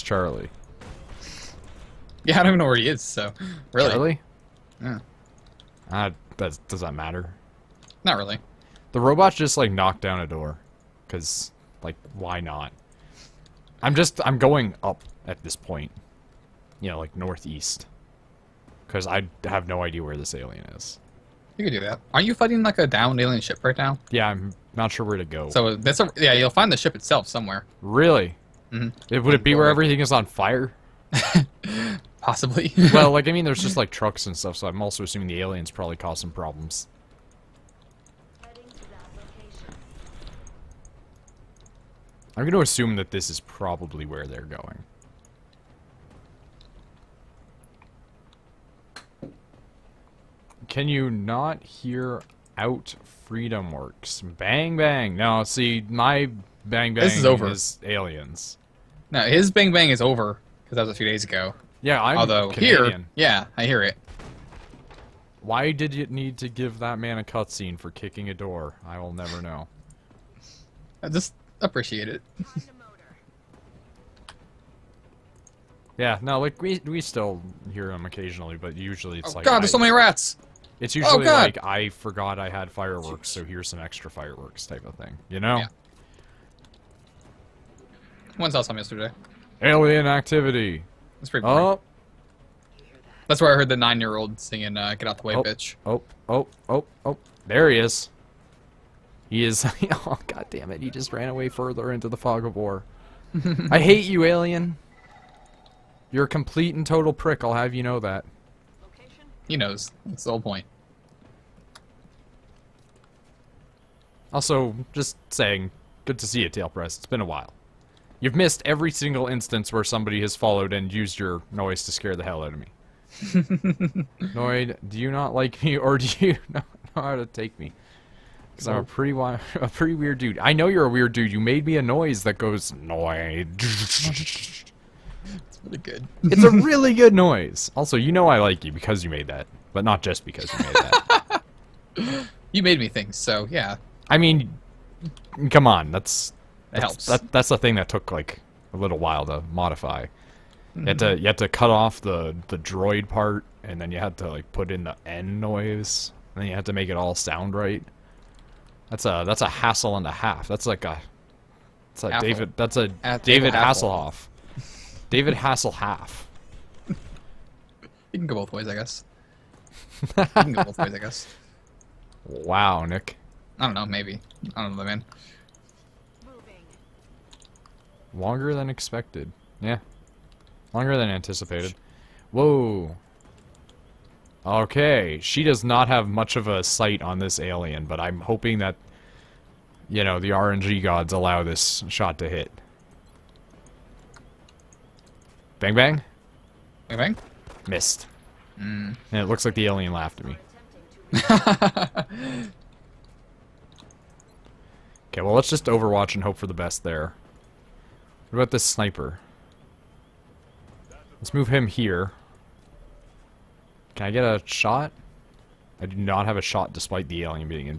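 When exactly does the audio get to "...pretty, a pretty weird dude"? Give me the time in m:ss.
2:08.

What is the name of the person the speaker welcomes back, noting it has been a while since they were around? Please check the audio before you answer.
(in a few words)
Tailpress.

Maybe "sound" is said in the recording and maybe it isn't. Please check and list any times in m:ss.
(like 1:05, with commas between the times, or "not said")
2:37.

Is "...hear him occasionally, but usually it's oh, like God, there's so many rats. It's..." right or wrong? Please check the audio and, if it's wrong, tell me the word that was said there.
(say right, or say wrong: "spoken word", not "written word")
right.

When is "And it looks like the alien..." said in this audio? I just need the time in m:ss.
3:19.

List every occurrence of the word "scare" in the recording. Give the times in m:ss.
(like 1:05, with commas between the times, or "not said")
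2:01.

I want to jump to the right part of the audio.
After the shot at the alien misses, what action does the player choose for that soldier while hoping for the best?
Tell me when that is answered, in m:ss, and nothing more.
3:25.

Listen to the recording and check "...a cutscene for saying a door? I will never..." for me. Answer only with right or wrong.
wrong.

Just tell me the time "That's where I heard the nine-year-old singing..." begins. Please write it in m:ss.
1:33.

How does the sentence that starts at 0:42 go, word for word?
I'm going to assume that this is probably where they're going.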